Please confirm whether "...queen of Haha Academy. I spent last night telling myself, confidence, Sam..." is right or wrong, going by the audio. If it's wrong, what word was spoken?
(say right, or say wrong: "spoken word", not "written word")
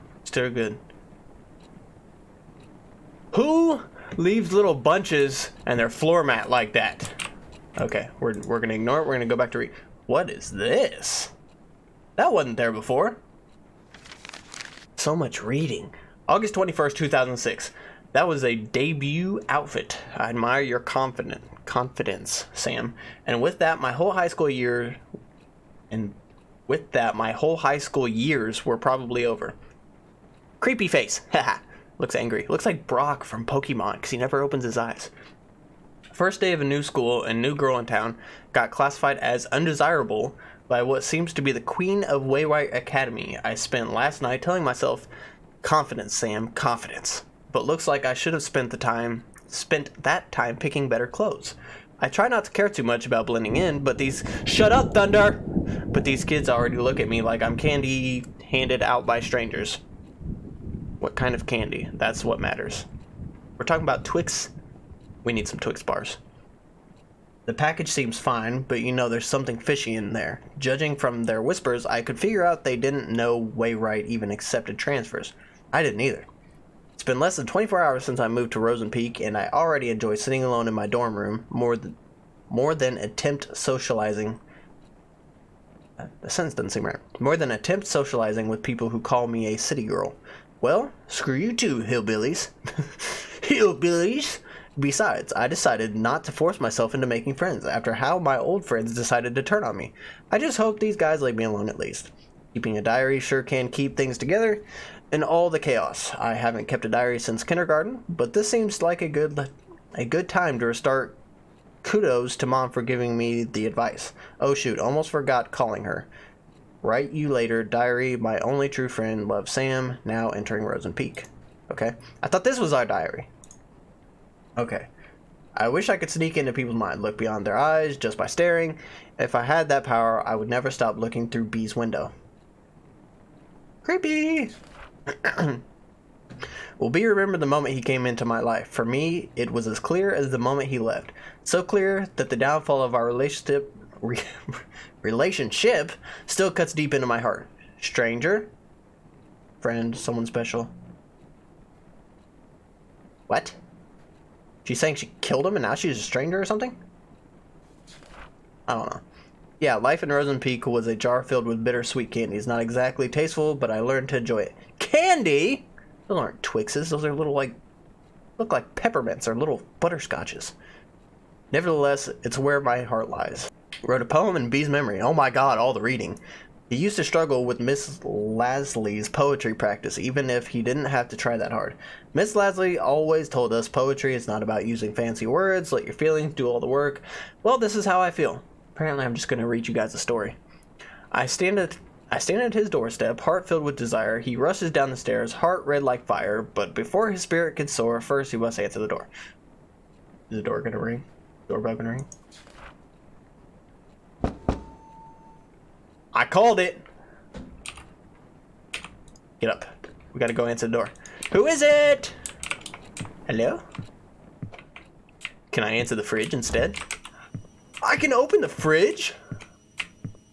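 wrong: "Waywire", not "Haha".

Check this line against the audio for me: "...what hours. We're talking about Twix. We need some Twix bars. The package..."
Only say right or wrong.
wrong.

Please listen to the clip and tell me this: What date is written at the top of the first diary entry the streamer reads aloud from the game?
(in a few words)
August 21st, 2006.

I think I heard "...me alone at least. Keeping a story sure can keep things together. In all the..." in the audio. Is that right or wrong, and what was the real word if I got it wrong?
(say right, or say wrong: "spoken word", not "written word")
wrong: "diary", not "story".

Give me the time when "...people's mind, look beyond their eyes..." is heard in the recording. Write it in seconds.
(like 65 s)
126 s.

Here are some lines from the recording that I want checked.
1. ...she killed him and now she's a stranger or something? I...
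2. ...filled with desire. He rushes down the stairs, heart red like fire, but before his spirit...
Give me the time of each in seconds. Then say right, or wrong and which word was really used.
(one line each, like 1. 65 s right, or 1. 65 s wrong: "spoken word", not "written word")
1. 154 s right
2. 193 s right.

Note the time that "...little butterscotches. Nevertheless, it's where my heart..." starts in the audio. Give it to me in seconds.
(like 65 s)
169 s.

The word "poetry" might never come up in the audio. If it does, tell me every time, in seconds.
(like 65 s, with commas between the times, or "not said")
179 s, 183 s.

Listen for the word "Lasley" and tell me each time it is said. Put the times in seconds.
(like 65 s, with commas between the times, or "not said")
178 s, 182 s.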